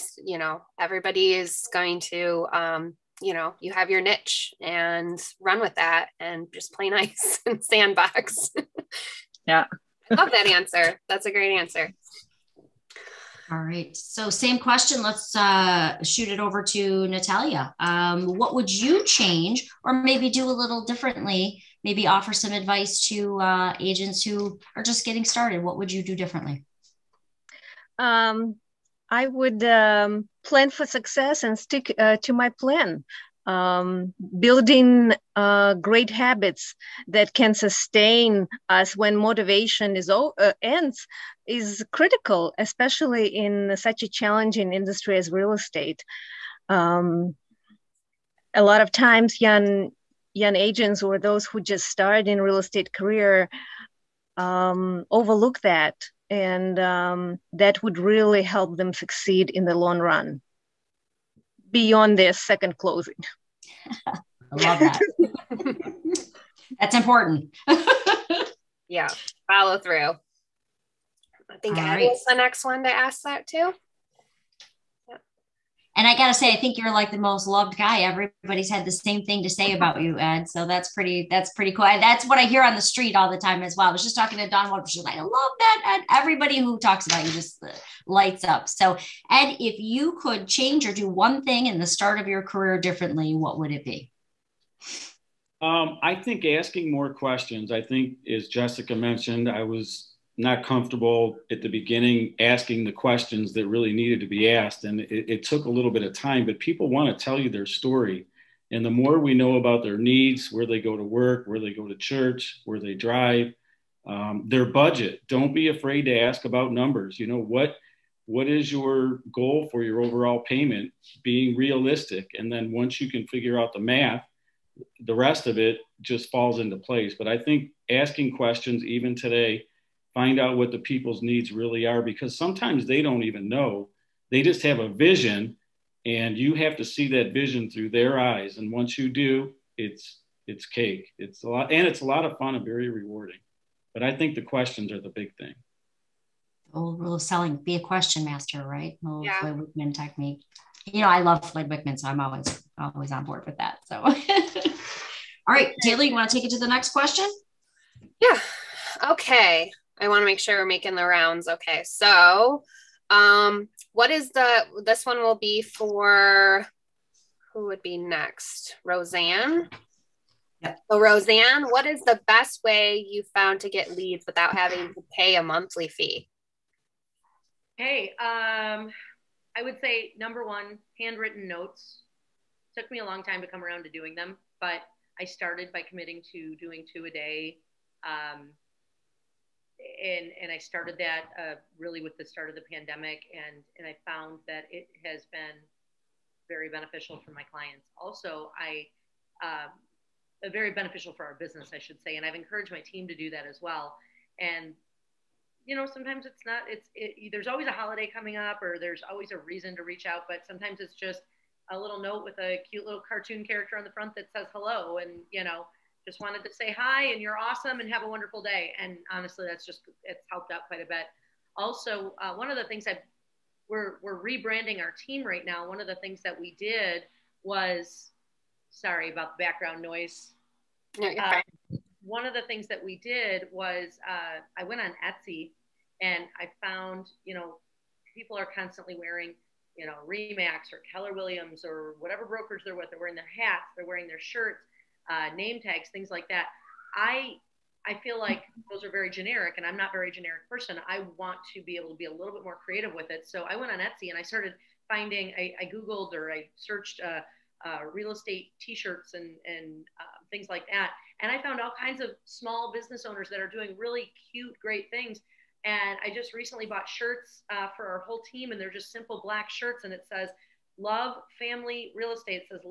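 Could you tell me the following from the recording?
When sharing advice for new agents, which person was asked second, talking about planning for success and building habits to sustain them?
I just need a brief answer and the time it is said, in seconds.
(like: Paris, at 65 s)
Natalia, at 17 s.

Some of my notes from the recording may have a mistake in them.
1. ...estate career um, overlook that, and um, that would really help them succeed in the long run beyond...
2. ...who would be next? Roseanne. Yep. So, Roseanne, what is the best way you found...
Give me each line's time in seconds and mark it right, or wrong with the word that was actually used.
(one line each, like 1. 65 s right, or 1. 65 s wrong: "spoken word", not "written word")
1. 52 s right
2. 167 s right.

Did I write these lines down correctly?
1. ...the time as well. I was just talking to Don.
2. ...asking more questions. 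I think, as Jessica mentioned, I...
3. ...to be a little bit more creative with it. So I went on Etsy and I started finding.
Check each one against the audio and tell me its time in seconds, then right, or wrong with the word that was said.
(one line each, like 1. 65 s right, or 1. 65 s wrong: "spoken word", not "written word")
1. 83 s right
2. 96 s right
3. 251 s right.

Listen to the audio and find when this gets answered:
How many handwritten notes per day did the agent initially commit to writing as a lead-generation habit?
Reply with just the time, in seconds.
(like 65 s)
186 s.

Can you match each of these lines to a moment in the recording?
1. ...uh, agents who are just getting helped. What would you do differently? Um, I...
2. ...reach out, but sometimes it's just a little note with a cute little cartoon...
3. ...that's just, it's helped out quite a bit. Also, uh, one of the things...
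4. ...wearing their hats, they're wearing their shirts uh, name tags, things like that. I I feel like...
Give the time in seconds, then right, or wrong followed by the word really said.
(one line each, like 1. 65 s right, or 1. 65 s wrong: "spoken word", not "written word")
1. 23 s wrong: "started", not "helped"
2. 209 s right
3. 219 s right
4. 242 s right.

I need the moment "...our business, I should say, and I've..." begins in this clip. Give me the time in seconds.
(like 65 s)
201 s.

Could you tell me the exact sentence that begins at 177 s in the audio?
Hey, um, I would say number one, handwritten notes.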